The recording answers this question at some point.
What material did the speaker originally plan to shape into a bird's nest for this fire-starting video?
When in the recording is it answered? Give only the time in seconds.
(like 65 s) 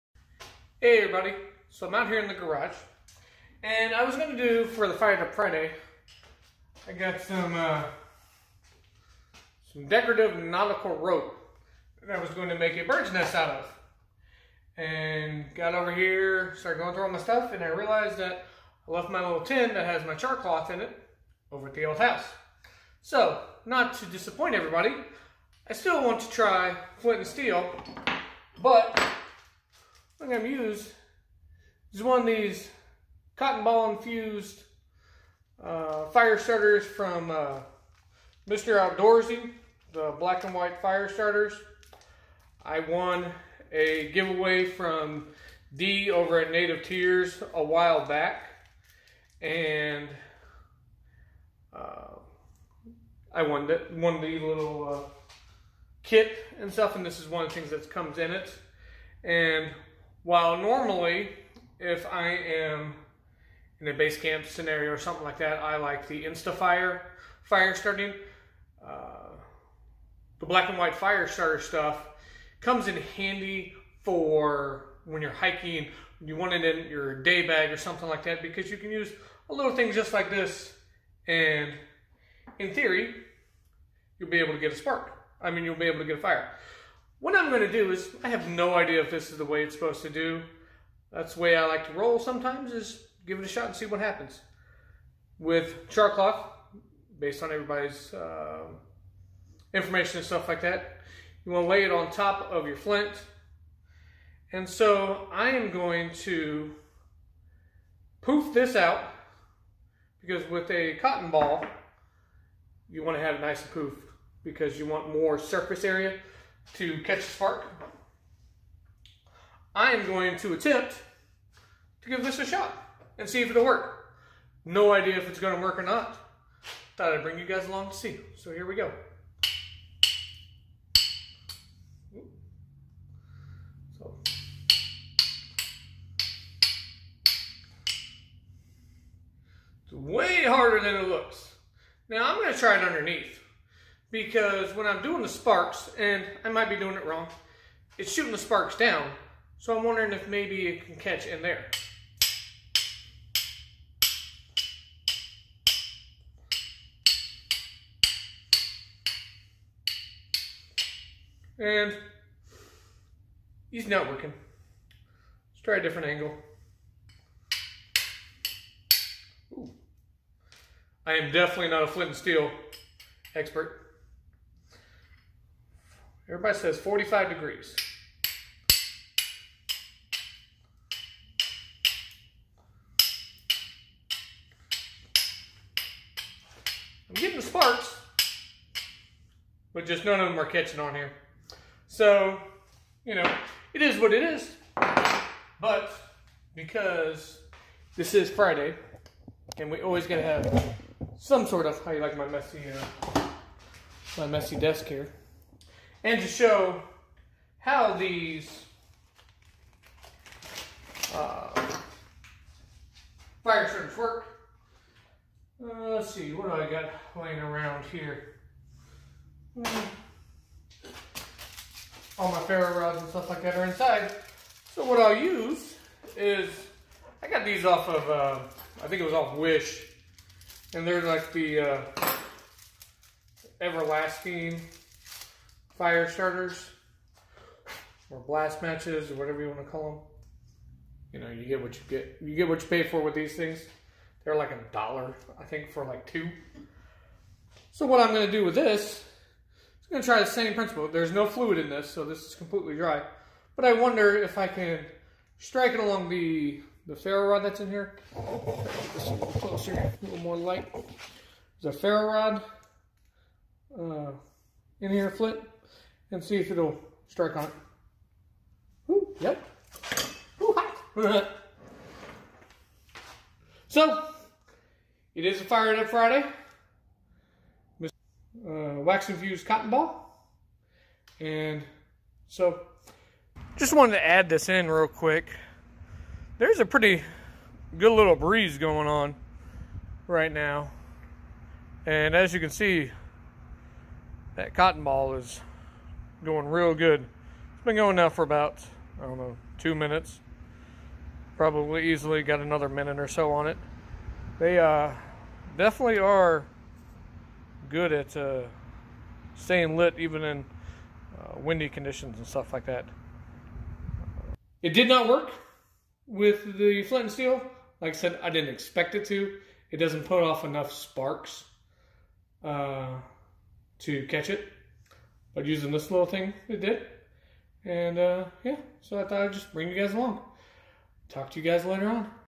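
9 s.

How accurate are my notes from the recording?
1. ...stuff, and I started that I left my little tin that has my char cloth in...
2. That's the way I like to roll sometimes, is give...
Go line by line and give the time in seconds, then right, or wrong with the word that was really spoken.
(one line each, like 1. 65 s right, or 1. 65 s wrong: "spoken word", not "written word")
1. 17 s wrong: "realized", not "started"
2. 91 s right.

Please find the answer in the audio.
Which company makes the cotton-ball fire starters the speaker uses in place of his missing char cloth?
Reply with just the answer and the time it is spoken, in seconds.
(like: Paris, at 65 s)
Mr. Outdoorsy, at 38 s.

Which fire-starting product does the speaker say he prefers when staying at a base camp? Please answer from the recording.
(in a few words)
Instafire.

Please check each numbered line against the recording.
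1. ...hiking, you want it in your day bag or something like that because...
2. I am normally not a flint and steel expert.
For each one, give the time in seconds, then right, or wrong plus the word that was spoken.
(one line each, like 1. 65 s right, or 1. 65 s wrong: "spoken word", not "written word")
1. 75 s right
2. 171 s wrong: "definitely", not "normally".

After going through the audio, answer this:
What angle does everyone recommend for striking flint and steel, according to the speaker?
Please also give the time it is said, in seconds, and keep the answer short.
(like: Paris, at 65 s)
45 degrees, at 176 s.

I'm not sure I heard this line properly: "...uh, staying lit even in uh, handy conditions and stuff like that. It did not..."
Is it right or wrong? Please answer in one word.
wrong.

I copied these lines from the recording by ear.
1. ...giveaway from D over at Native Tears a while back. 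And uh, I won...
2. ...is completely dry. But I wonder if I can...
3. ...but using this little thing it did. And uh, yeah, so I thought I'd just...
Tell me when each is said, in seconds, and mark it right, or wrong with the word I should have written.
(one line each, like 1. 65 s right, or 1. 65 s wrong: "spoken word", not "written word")
1. 44 s right
2. 252 s right
3. 325 s right.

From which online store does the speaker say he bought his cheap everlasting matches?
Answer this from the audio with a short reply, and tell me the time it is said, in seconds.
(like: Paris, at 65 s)
Wish, at 229 s.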